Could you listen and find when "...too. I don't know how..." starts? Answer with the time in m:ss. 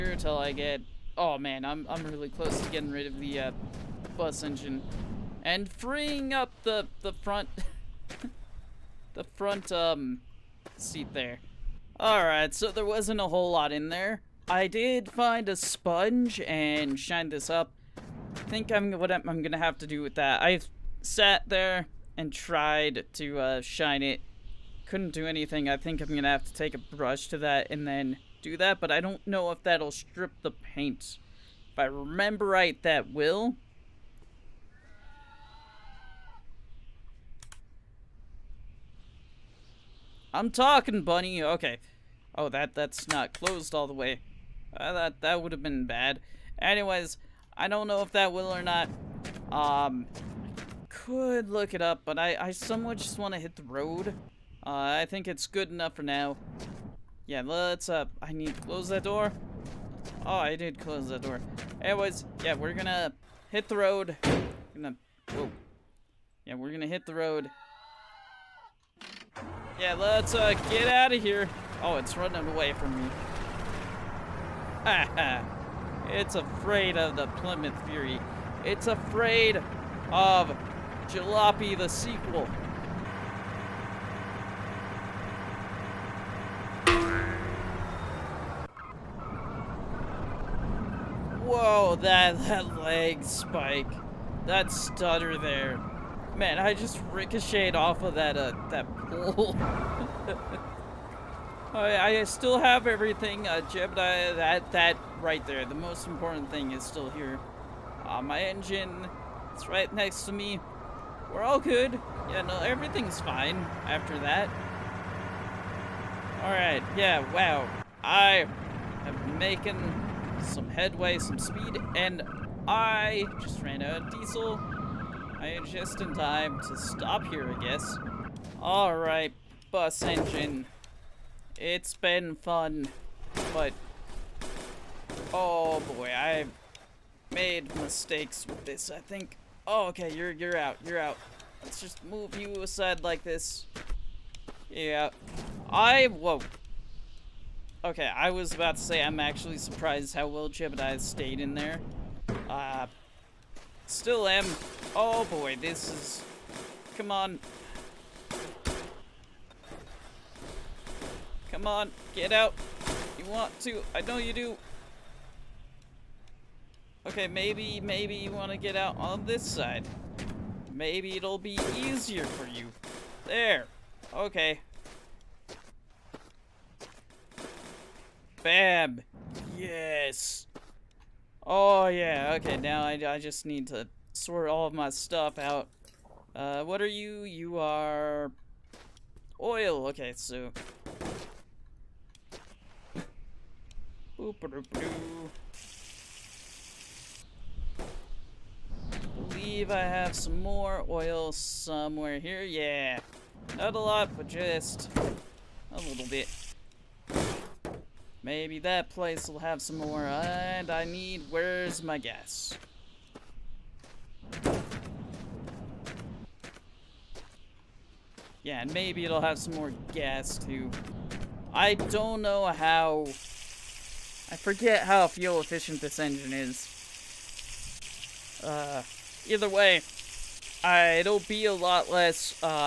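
3:40.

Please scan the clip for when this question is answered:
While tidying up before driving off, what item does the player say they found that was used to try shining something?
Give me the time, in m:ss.
0:15.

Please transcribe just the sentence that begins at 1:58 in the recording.
I am making some headway, some speed, and I just ran out of diesel.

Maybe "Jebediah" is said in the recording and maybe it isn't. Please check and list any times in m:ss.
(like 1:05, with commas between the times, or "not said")
1:43, 2:30.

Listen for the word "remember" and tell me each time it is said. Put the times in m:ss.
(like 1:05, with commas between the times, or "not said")
0:31.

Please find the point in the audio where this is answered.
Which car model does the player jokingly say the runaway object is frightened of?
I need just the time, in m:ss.
1:17.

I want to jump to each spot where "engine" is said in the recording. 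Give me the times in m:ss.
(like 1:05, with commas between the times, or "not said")
0:04, 1:48, 2:10, 3:46.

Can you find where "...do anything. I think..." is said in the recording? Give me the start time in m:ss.
0:25.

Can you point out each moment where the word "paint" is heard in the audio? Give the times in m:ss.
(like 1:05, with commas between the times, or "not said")
0:30.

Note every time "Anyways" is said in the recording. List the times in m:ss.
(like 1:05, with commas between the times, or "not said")
0:46, 1:01.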